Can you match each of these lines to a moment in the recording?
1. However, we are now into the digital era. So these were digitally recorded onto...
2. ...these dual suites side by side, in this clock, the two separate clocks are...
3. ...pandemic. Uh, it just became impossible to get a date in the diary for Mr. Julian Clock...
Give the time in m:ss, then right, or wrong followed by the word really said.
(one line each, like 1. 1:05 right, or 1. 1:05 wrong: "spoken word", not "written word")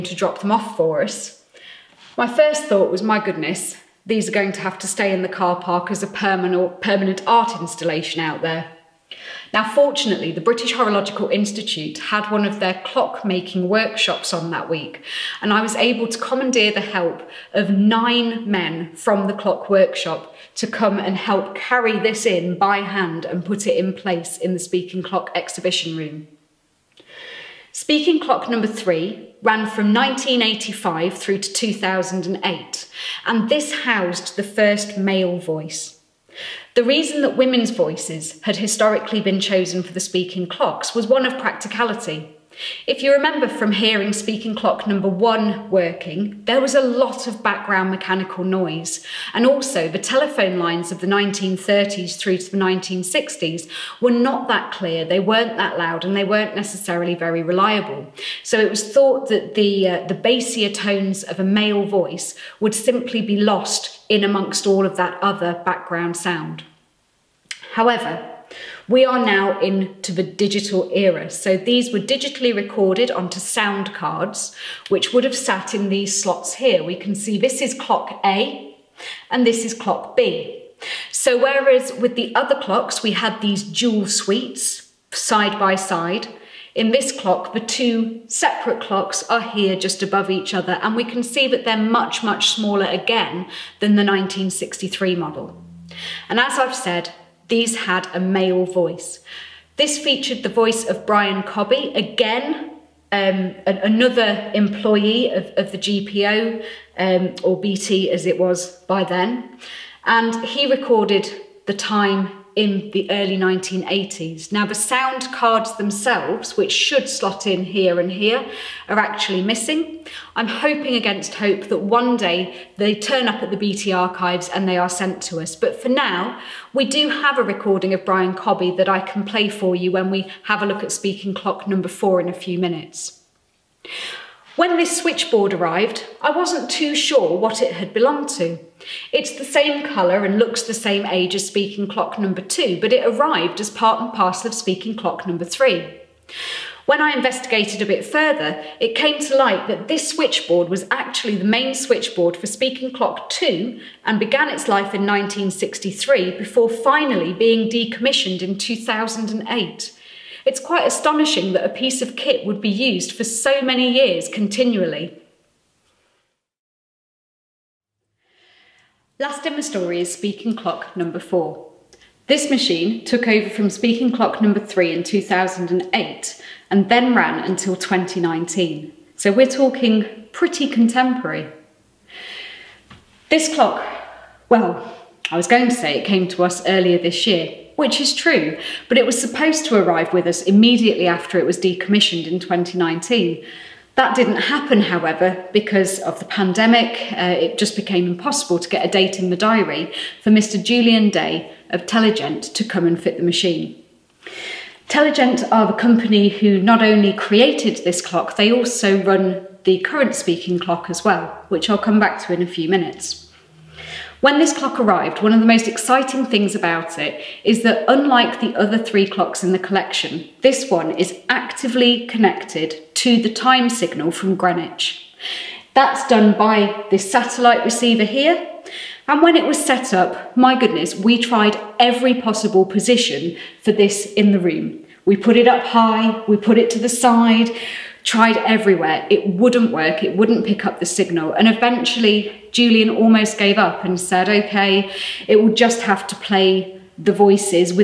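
1. 1:07 right
2. 1:23 right
3. 3:16 wrong: "Day", not "Clock".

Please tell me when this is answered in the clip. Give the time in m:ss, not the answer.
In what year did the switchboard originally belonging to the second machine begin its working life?
2:34.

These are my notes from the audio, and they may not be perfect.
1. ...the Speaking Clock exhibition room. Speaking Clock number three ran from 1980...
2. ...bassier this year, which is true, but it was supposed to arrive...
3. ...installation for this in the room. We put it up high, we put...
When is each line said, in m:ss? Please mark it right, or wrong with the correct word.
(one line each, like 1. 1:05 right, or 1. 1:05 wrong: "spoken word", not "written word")
1. 0:24 wrong: "1985", not "1980"
2. 3:06 wrong: "earlier", not "bassier"
3. 3:52 wrong: "position", not "installation".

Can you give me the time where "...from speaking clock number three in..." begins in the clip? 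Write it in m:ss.
2:53.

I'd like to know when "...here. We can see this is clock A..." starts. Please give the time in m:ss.
1:16.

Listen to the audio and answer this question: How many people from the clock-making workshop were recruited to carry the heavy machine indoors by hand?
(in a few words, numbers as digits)
9.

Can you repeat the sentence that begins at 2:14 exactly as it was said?
When this switchboard arrived, I wasn't too sure what it had belonged to.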